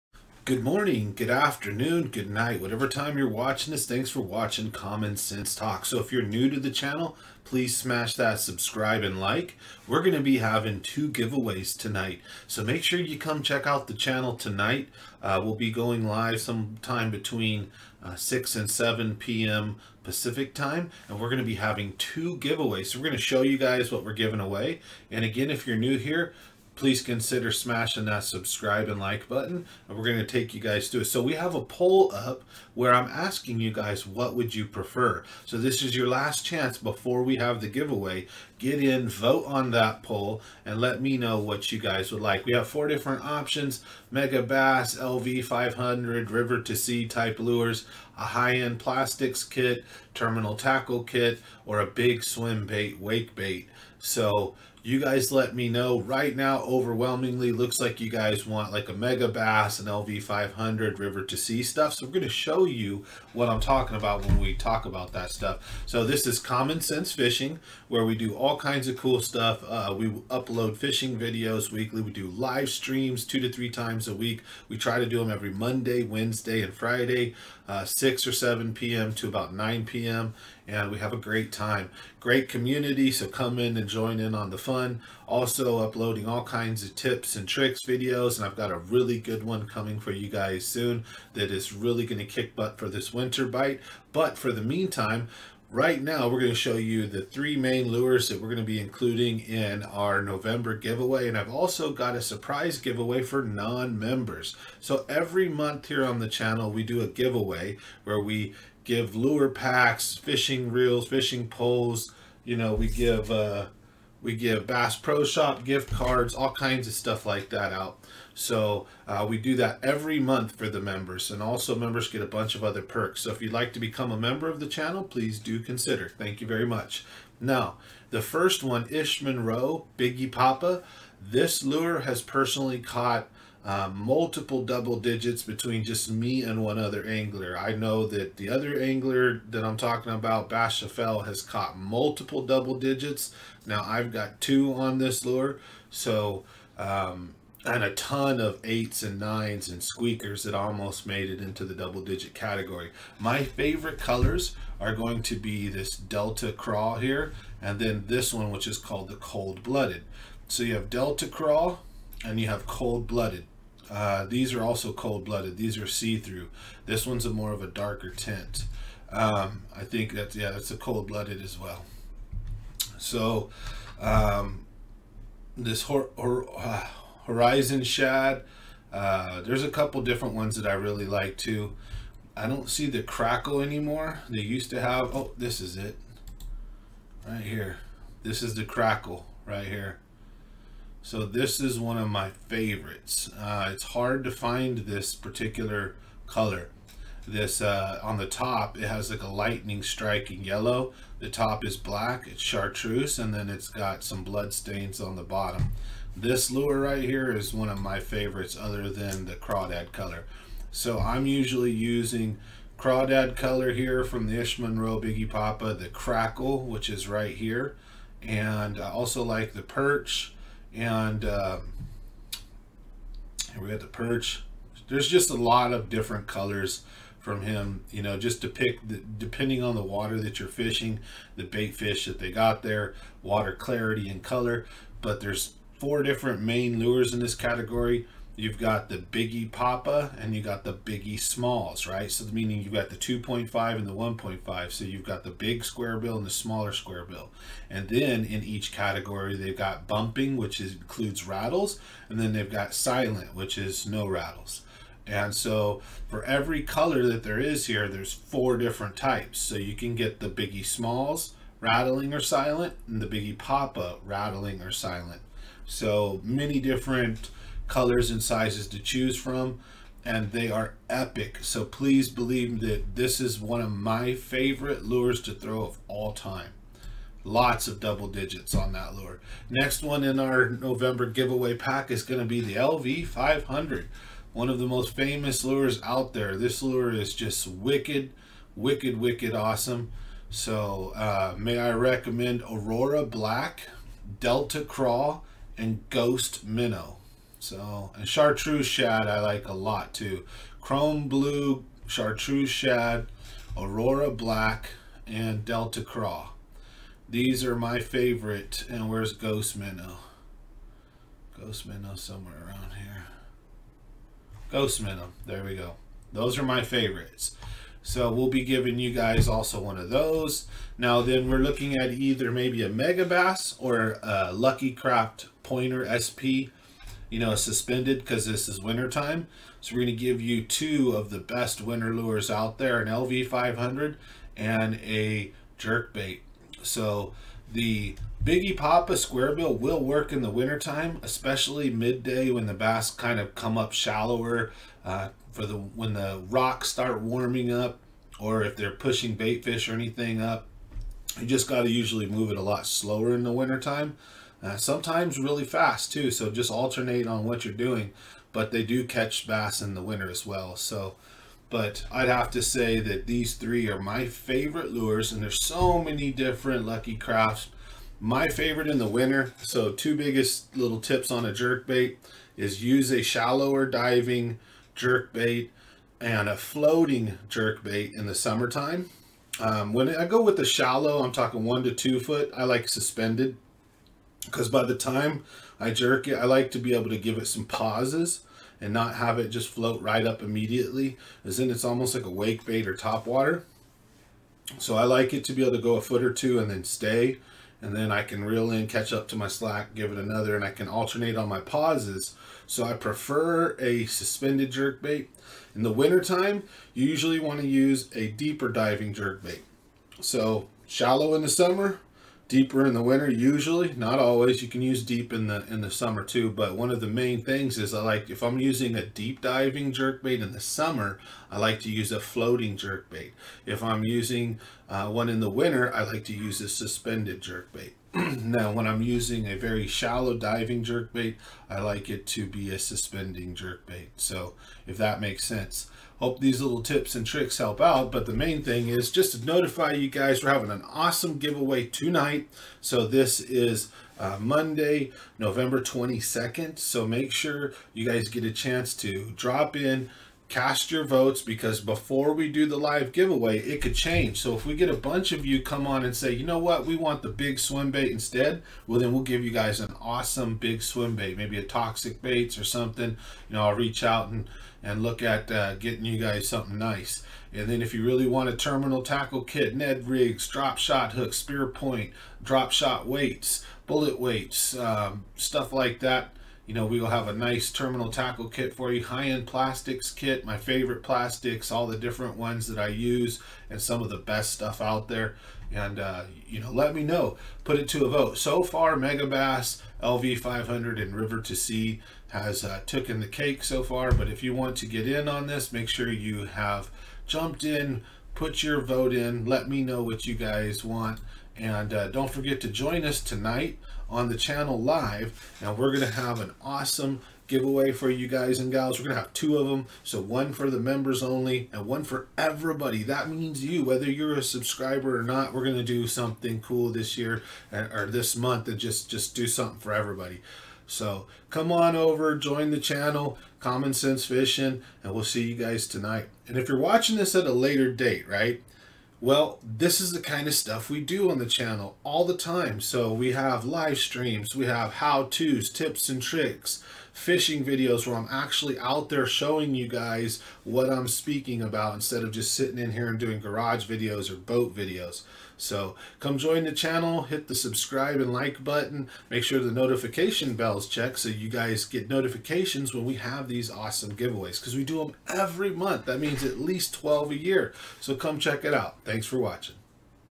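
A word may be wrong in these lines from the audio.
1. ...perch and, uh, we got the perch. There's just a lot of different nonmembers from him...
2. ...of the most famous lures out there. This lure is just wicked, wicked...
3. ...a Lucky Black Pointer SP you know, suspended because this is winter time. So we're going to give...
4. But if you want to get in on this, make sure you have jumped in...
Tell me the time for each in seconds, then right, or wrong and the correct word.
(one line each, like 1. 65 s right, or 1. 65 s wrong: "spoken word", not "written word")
1. 219 s wrong: "colors", not "nonmembers"
2. 284 s right
3. 324 s wrong: "Craft", not "Black"
4. 493 s right.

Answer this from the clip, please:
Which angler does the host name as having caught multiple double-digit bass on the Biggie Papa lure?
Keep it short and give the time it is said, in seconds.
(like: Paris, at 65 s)
Bashafel, at 140 s.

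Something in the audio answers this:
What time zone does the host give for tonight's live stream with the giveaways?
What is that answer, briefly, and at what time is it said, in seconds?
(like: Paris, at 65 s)
Pacific, at 20 s.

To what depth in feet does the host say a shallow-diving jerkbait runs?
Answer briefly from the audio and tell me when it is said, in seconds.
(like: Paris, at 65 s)
1 to 2 feet, at 381 s.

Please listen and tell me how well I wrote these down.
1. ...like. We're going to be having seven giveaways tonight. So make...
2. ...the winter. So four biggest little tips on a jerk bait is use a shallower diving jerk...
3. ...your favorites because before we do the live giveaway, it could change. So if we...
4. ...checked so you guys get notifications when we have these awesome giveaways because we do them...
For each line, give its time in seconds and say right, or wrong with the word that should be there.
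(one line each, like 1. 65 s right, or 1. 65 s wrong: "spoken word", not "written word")
1. 9 s wrong: "two", not "seven"
2. 368 s wrong: "two", not "four"
3. 450 s wrong: "votes", not "favorites"
4. 550 s right.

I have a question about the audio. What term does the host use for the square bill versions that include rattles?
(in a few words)
Bumping.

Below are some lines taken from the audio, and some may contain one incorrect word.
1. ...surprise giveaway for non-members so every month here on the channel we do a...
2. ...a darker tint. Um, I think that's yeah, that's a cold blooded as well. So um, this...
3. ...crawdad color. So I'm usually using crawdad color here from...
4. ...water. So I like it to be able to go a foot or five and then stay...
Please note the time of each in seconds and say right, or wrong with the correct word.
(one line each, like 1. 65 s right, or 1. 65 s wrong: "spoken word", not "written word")
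1. 102 s right
2. 167 s right
3. 209 s right
4. 393 s wrong: "two", not "five".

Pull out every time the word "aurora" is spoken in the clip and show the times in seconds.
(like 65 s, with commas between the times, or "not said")
292 s, 303 s.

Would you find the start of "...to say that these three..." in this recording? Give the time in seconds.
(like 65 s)
362 s.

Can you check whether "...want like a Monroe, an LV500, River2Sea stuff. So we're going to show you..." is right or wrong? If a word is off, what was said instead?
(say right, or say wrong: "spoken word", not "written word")
wrong: "Megabass", not "Monroe".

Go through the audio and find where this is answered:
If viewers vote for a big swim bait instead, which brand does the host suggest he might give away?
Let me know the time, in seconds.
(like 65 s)
461 s.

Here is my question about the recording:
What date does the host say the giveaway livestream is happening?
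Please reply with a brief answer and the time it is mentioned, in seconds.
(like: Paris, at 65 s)
Monday, November 22nd, at 444 s.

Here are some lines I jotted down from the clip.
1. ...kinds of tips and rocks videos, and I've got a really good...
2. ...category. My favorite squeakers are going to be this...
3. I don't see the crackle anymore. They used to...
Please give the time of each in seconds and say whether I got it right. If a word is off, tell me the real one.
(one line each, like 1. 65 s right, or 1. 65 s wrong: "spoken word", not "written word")
1. 86 s wrong: "tricks", not "rocks"
2. 152 s wrong: "colors", not "squeakers"
3. 182 s right.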